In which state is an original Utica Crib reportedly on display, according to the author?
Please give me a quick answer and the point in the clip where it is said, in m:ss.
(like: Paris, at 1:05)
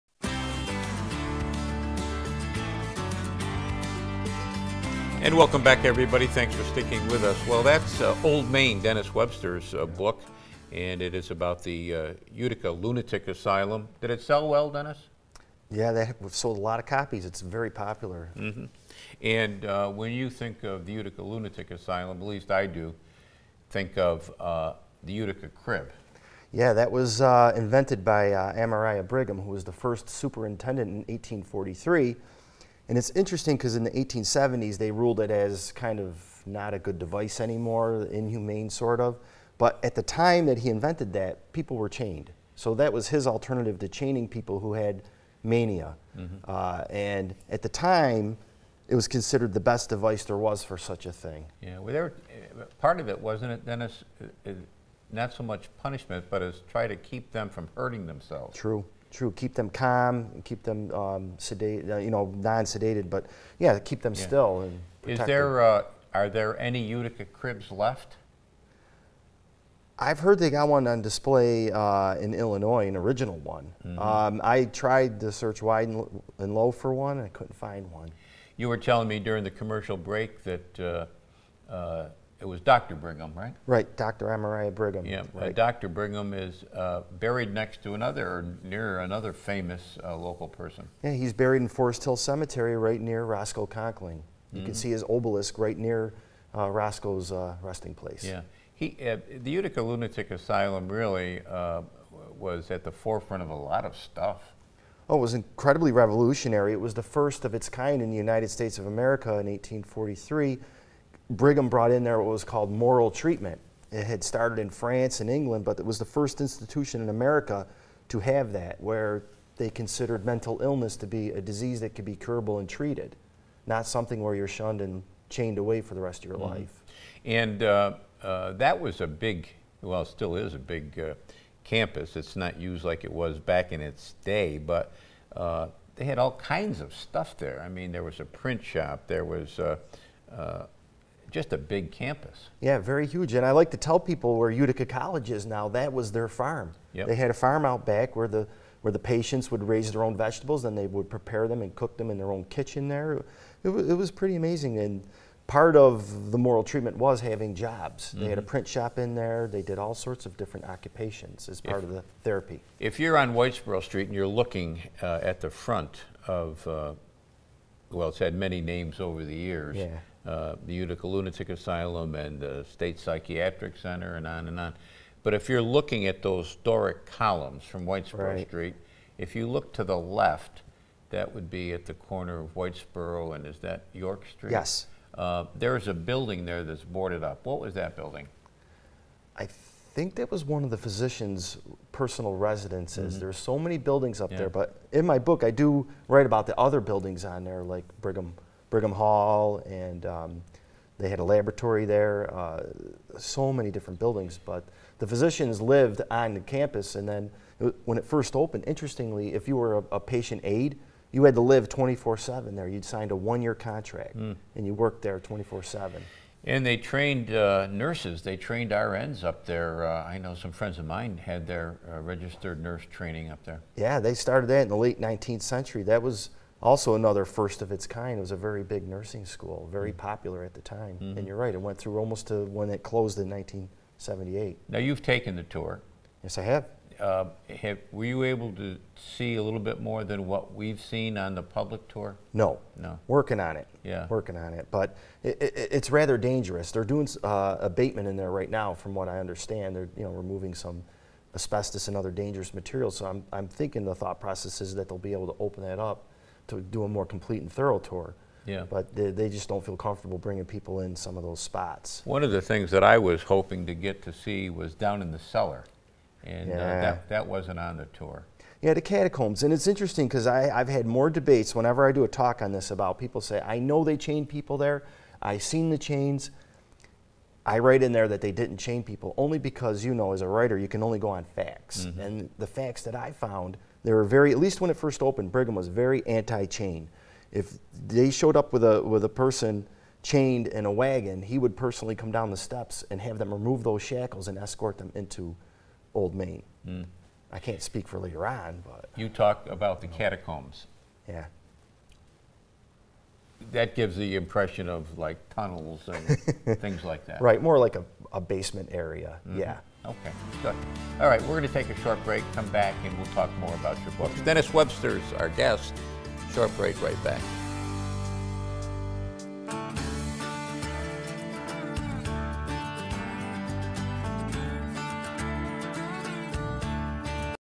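Illinois, at 1:12.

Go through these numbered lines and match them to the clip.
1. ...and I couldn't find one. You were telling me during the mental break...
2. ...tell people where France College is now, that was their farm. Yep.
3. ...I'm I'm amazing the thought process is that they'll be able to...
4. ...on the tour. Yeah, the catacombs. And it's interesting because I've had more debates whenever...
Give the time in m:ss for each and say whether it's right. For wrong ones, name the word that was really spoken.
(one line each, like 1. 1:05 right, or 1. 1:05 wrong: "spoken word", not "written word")
1. 1:17 wrong: "commercial", not "mental"
2. 2:23 wrong: "Utica", not "France"
3. 4:13 wrong: "thinking", not "amazing"
4. 4:27 right.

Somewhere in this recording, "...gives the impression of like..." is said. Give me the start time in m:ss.
5:03.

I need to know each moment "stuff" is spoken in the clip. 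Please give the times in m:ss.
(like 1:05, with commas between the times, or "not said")
1:43, 2:16.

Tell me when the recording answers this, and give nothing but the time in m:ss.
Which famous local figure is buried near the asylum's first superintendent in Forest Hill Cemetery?
1:33.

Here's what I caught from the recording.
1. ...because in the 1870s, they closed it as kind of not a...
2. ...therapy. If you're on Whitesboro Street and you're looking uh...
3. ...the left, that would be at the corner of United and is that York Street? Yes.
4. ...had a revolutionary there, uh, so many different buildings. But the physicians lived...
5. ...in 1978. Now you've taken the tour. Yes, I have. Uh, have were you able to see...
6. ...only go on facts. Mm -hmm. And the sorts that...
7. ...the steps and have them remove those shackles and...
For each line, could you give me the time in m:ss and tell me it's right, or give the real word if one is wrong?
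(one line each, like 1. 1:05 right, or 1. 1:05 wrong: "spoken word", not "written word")
1. 0:33 wrong: "ruled", not "closed"
2. 2:42 right
3. 2:59 wrong: "Whitesboro", not "United"
4. 3:21 wrong: "laboratory", not "revolutionary"
5. 3:53 right
6. 4:40 wrong: "facts", not "sorts"
7. 4:52 right.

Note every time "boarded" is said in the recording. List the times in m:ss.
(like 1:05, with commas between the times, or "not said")
3:06.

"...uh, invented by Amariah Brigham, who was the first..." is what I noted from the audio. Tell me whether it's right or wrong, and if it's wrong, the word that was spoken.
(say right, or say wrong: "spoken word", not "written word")
right.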